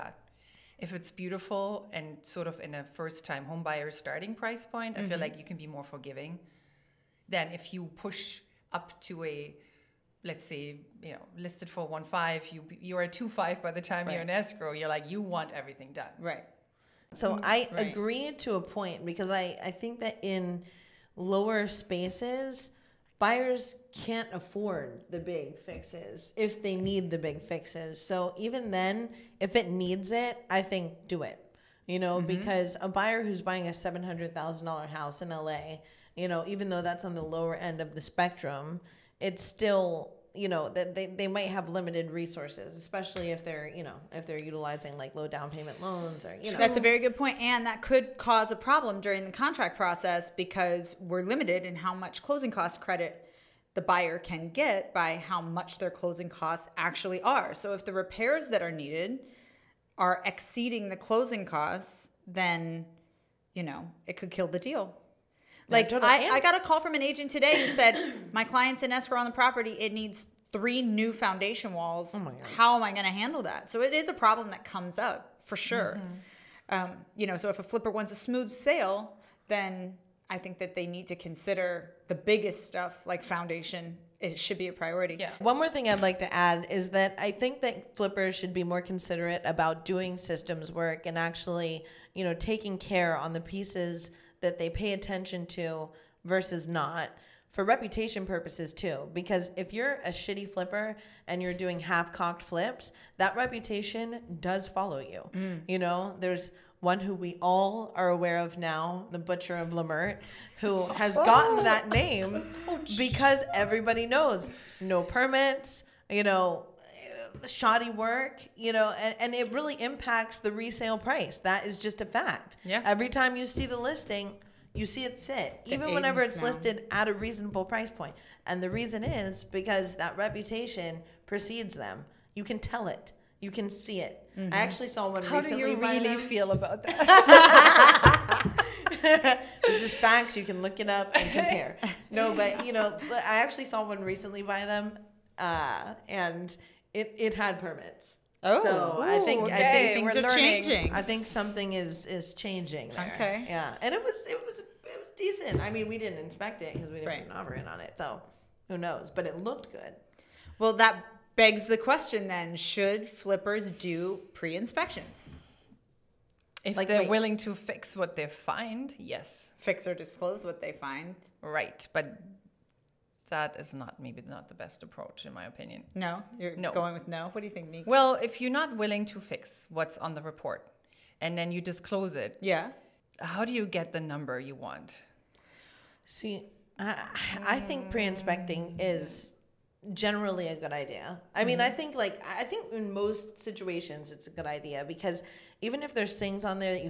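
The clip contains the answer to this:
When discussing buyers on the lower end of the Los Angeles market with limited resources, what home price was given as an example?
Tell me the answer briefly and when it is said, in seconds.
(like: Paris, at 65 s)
$700,000, at 33 s.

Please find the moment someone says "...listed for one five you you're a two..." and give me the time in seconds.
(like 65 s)
11 s.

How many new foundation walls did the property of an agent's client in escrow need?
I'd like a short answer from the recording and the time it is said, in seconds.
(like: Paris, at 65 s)
3, at 70 s.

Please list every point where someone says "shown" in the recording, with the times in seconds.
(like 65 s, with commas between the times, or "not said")
not said.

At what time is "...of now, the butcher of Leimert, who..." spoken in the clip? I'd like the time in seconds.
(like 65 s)
108 s.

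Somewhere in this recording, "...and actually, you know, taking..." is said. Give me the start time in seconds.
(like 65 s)
91 s.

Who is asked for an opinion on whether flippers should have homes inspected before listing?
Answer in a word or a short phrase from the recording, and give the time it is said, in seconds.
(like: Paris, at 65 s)
Nick, at 177 s.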